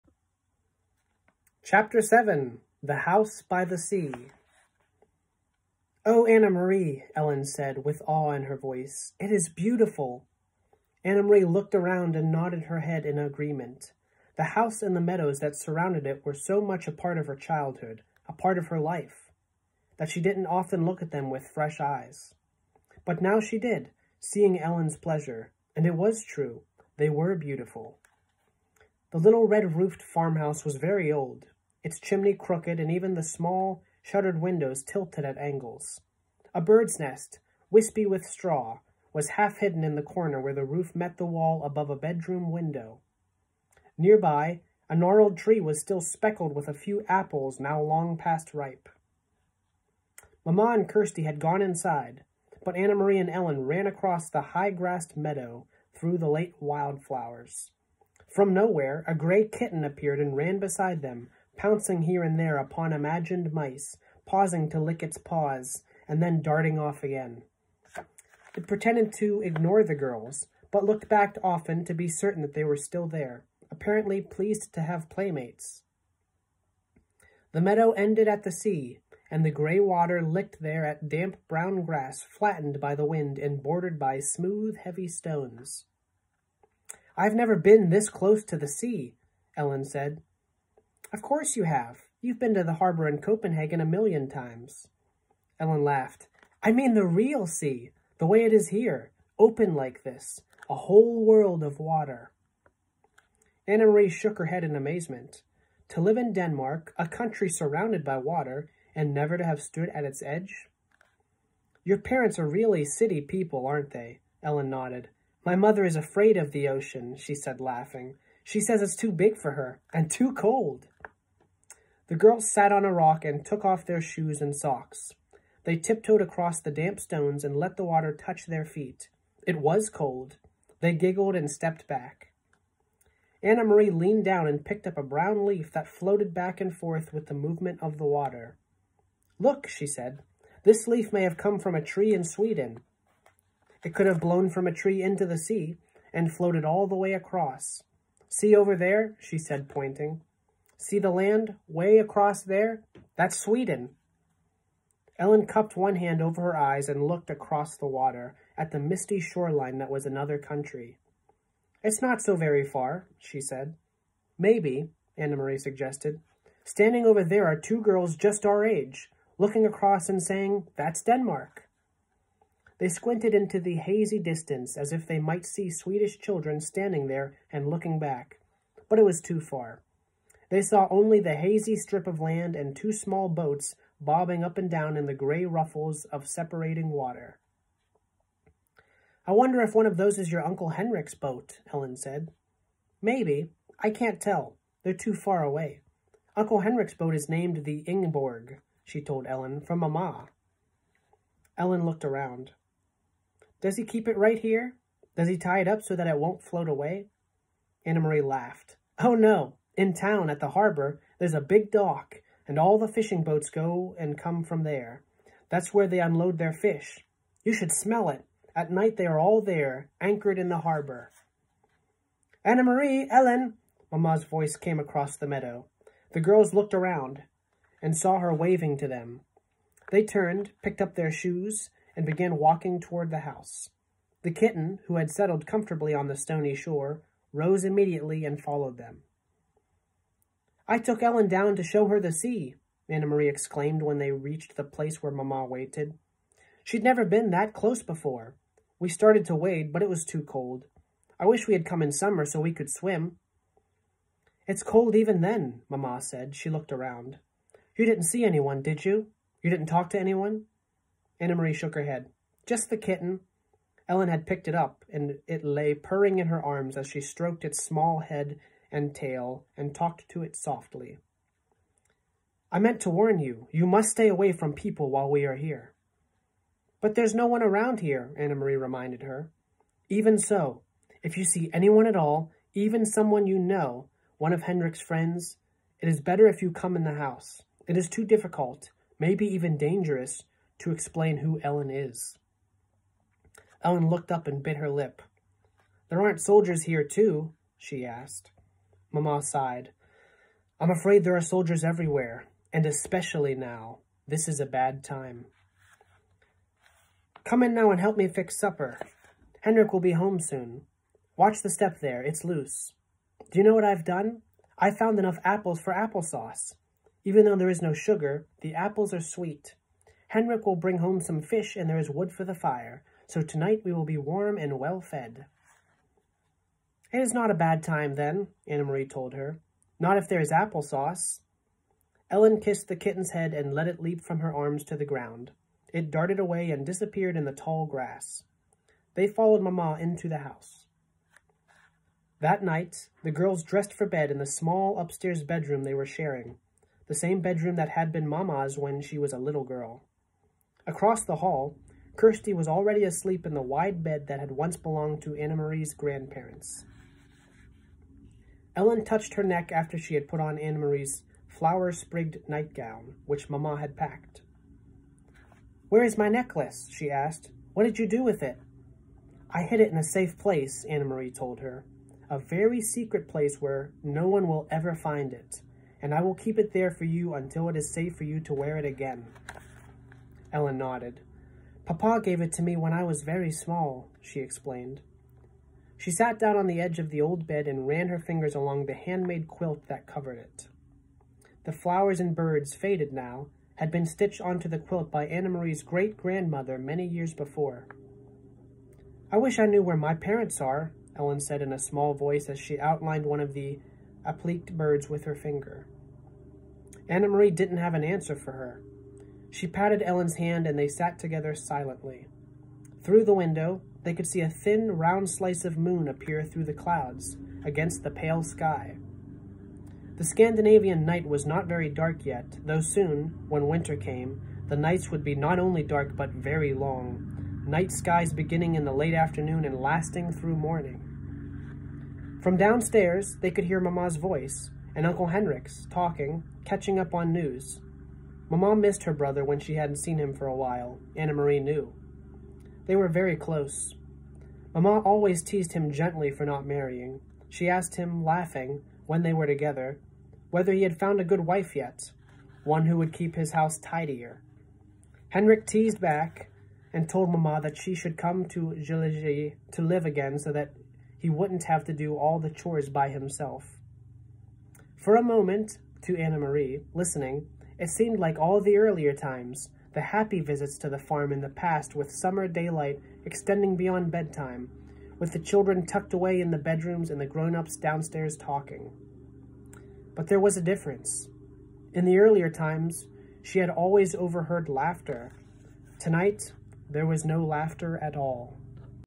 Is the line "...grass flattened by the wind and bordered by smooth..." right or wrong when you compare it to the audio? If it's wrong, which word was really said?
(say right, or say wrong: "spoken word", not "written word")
right.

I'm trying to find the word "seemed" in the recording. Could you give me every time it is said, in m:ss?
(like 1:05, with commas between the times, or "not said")
7:47.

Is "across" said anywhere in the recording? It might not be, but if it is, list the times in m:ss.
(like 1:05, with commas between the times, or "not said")
0:53, 2:06, 2:27, 2:31, 2:37, 2:49, 3:44, 5:50.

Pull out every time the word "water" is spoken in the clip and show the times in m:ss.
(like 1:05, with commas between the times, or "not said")
1:19, 1:41, 1:48, 2:07, 2:18, 2:37, 3:06.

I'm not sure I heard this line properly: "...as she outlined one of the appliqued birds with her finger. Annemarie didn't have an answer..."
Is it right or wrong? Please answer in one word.
right.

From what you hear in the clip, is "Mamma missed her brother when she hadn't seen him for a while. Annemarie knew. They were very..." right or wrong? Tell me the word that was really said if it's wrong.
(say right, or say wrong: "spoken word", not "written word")
right.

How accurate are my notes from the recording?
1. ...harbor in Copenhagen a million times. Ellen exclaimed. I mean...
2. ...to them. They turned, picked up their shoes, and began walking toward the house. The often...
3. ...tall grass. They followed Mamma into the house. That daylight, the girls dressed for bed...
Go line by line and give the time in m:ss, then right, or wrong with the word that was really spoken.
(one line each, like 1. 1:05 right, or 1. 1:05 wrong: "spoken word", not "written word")
1. 1:32 wrong: "laughed", not "exclaimed"
2. 3:48 wrong: "kitten", not "often"
3. 5:37 wrong: "night", not "daylight".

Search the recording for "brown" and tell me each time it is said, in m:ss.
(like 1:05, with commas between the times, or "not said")
1:21, 2:15.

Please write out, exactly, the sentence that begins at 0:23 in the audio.
But now she did, seeing Ellen's pleasure, and it was true.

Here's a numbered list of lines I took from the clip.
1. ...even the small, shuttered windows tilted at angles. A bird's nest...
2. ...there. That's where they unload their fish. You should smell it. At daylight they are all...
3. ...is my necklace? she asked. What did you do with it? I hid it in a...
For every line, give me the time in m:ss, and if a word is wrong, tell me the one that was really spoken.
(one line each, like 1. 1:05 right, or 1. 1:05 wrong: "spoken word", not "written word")
1. 0:32 right
2. 3:34 wrong: "night", not "daylight"
3. 6:05 right.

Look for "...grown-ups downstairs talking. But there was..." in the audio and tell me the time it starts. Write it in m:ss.
7:57.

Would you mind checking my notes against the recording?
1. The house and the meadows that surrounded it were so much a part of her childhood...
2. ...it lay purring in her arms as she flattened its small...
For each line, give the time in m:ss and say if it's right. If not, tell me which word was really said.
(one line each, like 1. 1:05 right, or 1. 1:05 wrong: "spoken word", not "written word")
1. 0:14 right
2. 4:25 wrong: "stroked", not "flattened".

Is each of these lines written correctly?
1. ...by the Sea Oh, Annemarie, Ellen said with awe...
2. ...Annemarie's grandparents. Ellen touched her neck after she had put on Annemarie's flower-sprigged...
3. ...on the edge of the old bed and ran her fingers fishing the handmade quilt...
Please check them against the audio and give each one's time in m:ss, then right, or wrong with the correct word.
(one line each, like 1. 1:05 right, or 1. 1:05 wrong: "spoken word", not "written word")
1. 0:03 right
2. 5:55 right
3. 6:26 wrong: "along", not "fishing".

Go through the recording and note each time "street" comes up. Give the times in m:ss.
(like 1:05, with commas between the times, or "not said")
not said.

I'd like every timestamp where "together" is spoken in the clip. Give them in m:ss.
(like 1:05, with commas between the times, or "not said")
6:50, 7:29.